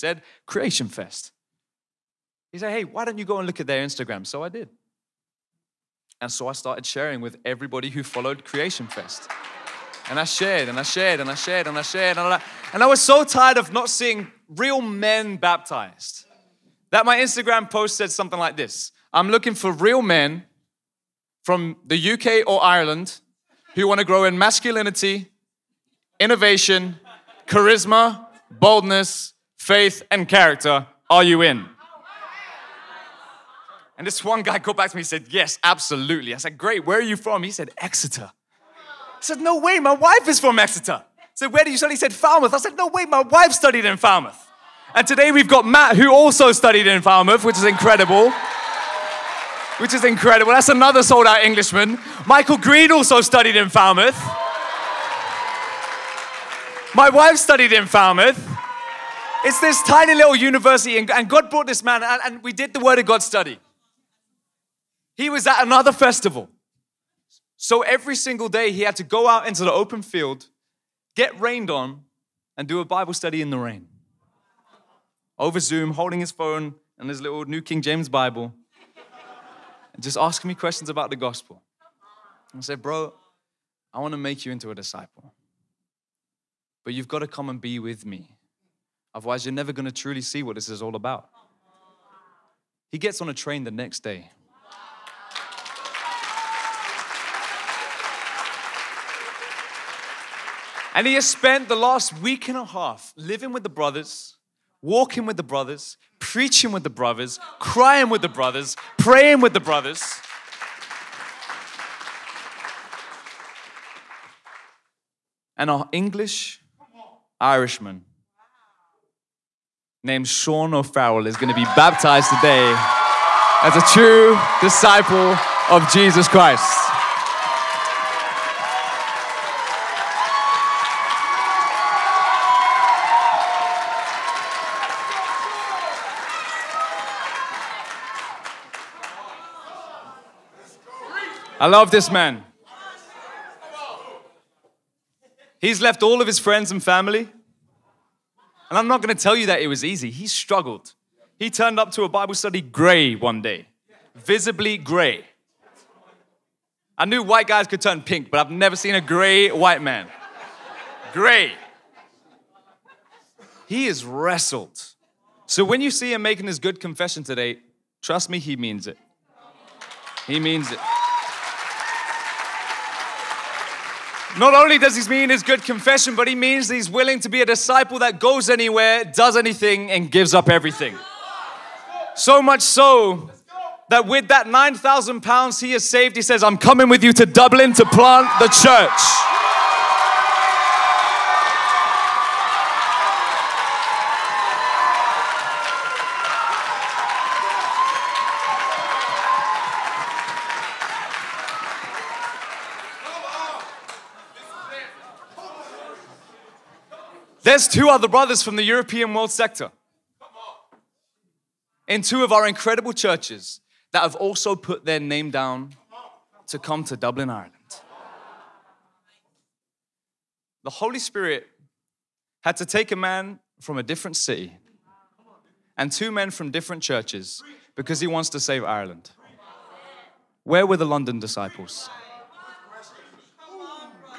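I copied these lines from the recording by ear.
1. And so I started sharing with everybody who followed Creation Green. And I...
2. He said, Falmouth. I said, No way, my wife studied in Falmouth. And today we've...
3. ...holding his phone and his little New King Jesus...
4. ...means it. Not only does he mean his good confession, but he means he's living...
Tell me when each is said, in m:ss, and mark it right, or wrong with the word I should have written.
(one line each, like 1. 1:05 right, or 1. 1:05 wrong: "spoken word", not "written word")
1. 0:06 wrong: "Fest", not "Green"
2. 0:41 right
3. 1:15 wrong: "James", not "Jesus"
4. 2:50 wrong: "willing", not "living".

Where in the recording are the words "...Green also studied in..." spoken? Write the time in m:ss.
0:52.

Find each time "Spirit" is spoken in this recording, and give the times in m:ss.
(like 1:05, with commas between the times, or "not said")
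3:40.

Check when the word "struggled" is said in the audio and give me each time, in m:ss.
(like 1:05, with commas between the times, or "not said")
2:30.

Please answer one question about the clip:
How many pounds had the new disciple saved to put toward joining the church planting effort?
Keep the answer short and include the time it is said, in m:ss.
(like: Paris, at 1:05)
9,000 pounds, at 3:04.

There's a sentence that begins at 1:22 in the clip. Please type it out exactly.
And I said, Bro, I want to make you into a disciple.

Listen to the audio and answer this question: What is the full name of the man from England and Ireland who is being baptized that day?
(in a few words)
Sean O'Farrell.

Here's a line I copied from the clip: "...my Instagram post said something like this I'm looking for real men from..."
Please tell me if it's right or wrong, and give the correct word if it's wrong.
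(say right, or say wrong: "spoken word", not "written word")
right.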